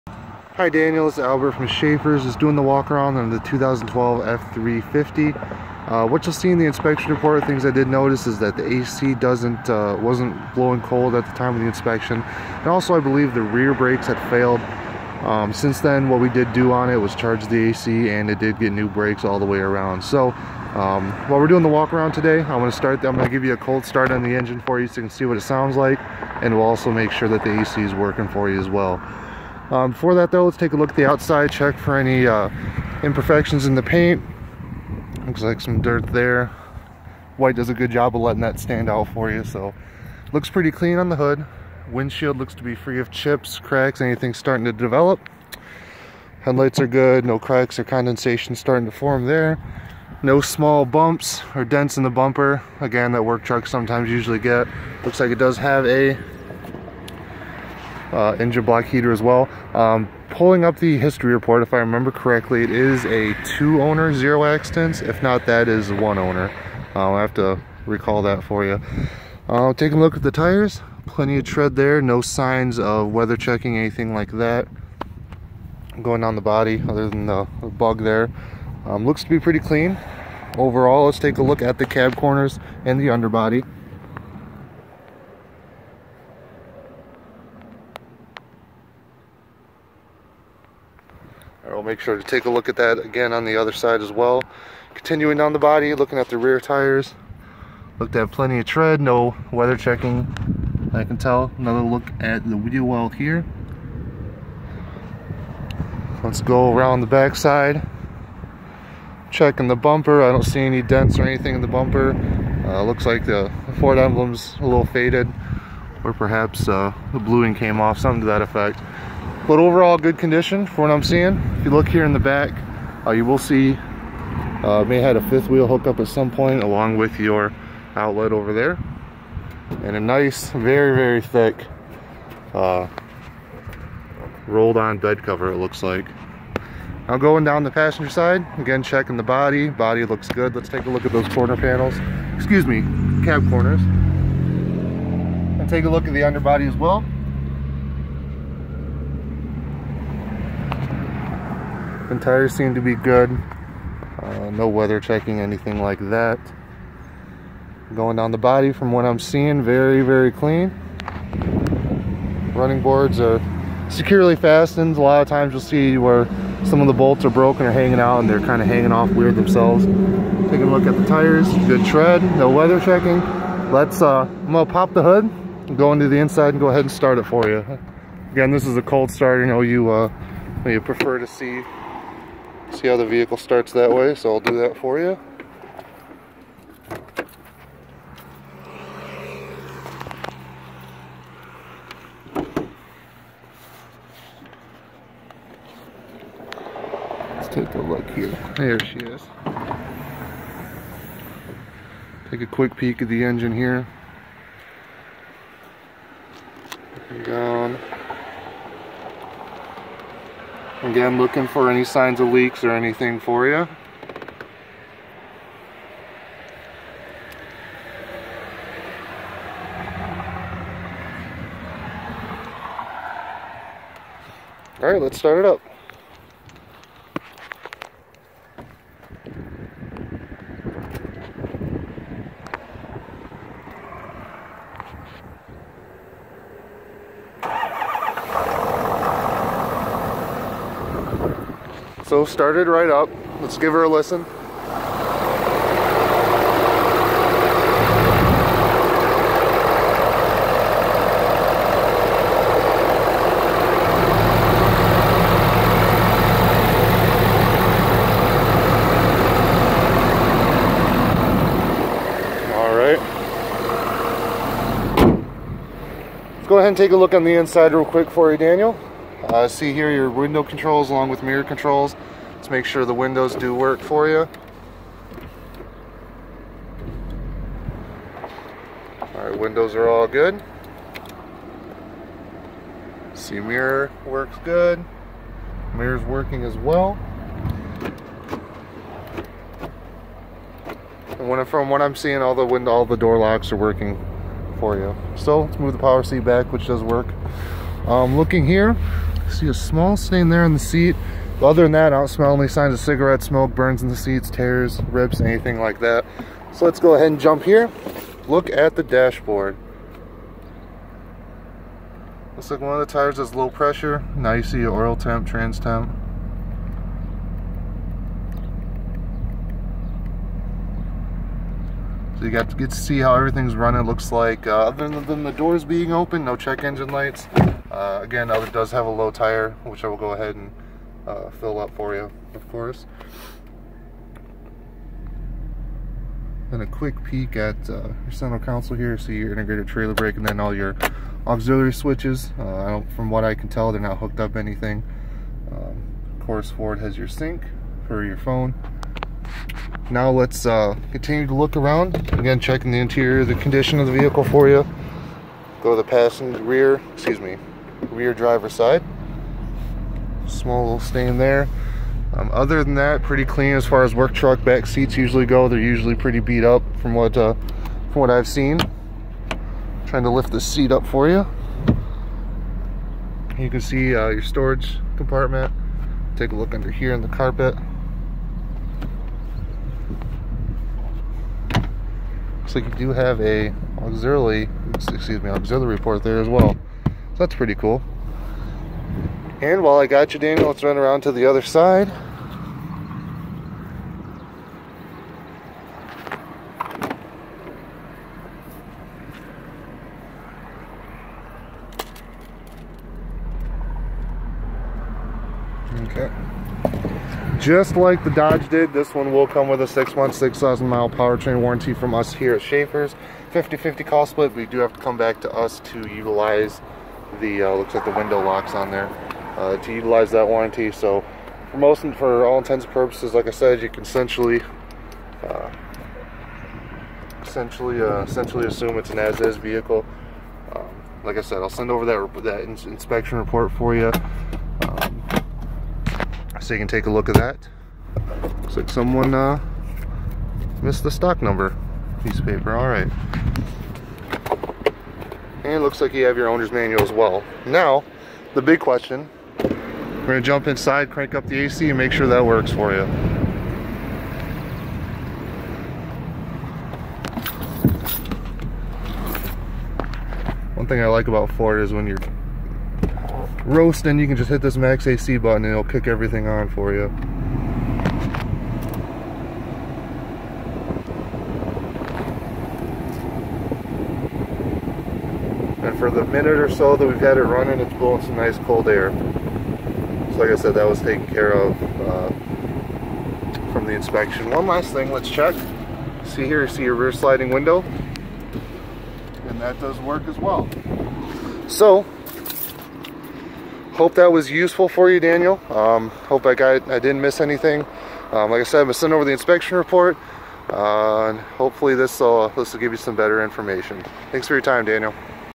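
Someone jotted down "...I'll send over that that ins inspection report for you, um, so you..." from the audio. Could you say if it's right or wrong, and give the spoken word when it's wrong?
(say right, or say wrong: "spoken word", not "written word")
right.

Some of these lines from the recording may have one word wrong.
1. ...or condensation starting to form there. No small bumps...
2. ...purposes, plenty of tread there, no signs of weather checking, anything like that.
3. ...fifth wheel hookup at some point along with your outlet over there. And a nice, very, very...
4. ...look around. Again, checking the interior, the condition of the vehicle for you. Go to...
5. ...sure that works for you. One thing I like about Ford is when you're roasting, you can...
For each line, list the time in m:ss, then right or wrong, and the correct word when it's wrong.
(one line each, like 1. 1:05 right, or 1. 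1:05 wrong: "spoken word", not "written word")
1. 0:47 right
2. 1:10 wrong: "tires", not "purposes"
3. 2:05 right
4. 5:51 right
5. 7:31 right.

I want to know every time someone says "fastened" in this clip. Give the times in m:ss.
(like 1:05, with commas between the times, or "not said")
2:44.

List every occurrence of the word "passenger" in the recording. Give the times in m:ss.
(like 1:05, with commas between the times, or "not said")
2:17, 5:55.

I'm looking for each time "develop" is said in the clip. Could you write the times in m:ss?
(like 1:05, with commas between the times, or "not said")
0:44.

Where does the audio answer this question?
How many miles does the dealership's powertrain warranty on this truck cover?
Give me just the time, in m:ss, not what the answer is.
6:50.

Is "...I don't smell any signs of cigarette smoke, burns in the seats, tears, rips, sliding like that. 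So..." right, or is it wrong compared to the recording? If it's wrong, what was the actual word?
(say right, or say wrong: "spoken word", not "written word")
wrong: "anything", not "sliding".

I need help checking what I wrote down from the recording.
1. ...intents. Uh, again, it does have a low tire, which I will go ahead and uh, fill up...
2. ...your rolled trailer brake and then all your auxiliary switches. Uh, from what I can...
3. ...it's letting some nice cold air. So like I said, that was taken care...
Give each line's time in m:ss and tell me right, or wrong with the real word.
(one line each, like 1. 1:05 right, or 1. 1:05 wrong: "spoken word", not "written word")
1. 5:26 wrong: "lights", not "intents"
2. 5:39 wrong: "integrated", not "rolled"
3. 7:57 wrong: "blowing", not "letting".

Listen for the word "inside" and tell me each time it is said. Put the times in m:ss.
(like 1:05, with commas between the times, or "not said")
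2:56, 4:27, 7:30.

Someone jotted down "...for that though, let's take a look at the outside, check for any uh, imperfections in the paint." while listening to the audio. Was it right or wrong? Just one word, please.
right.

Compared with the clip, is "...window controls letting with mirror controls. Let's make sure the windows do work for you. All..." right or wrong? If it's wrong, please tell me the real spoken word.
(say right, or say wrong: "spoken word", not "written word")
wrong: "along", not "letting".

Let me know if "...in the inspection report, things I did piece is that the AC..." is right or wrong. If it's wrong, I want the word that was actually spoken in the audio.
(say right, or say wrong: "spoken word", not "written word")
wrong: "notice", not "piece".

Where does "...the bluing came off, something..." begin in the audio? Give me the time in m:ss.
1:57.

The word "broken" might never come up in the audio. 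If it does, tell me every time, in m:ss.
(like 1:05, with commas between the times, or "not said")
2:47.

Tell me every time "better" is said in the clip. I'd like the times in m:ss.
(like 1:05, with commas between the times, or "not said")
8:22.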